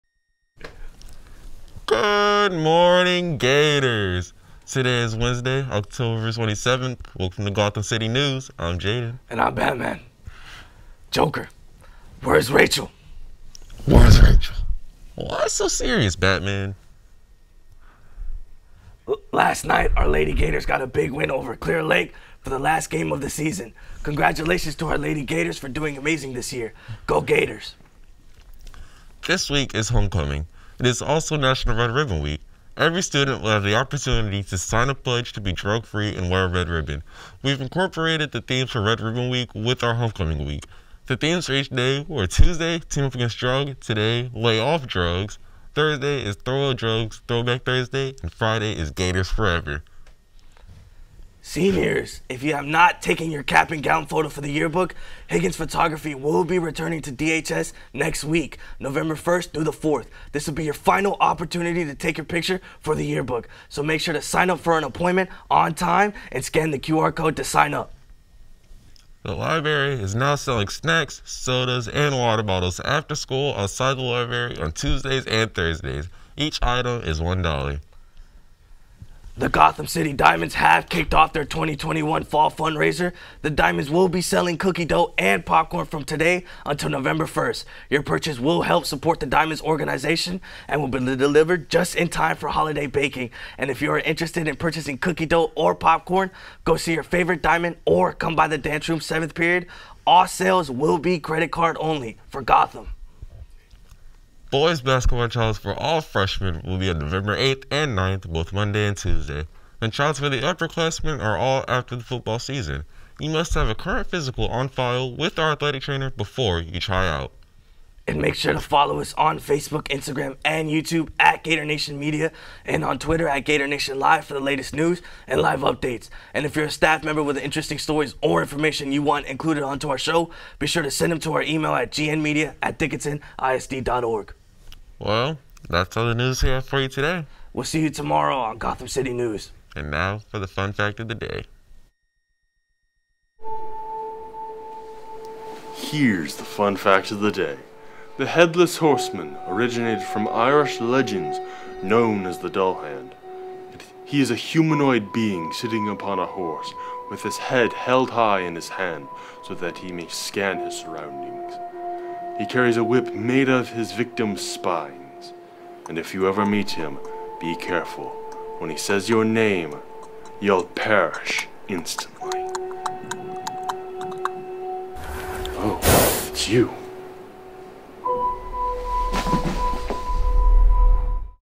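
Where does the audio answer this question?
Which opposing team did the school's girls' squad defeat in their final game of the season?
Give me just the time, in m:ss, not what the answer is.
0:21.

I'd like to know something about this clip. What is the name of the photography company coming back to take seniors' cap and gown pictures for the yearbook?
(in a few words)
Higgins Photography.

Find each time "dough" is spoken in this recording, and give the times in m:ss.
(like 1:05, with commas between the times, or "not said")
1:24, 1:35.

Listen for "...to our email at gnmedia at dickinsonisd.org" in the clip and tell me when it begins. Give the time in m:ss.
2:11.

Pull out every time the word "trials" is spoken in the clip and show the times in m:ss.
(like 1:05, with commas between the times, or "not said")
1:45, 1:49.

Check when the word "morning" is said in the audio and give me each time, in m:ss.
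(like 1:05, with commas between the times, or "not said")
0:02.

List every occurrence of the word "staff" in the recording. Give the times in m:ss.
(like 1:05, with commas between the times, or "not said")
2:06.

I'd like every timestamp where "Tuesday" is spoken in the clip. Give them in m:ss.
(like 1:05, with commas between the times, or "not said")
0:42, 1:14, 1:48.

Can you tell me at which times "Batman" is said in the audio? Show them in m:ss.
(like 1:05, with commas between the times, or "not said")
0:09, 0:16.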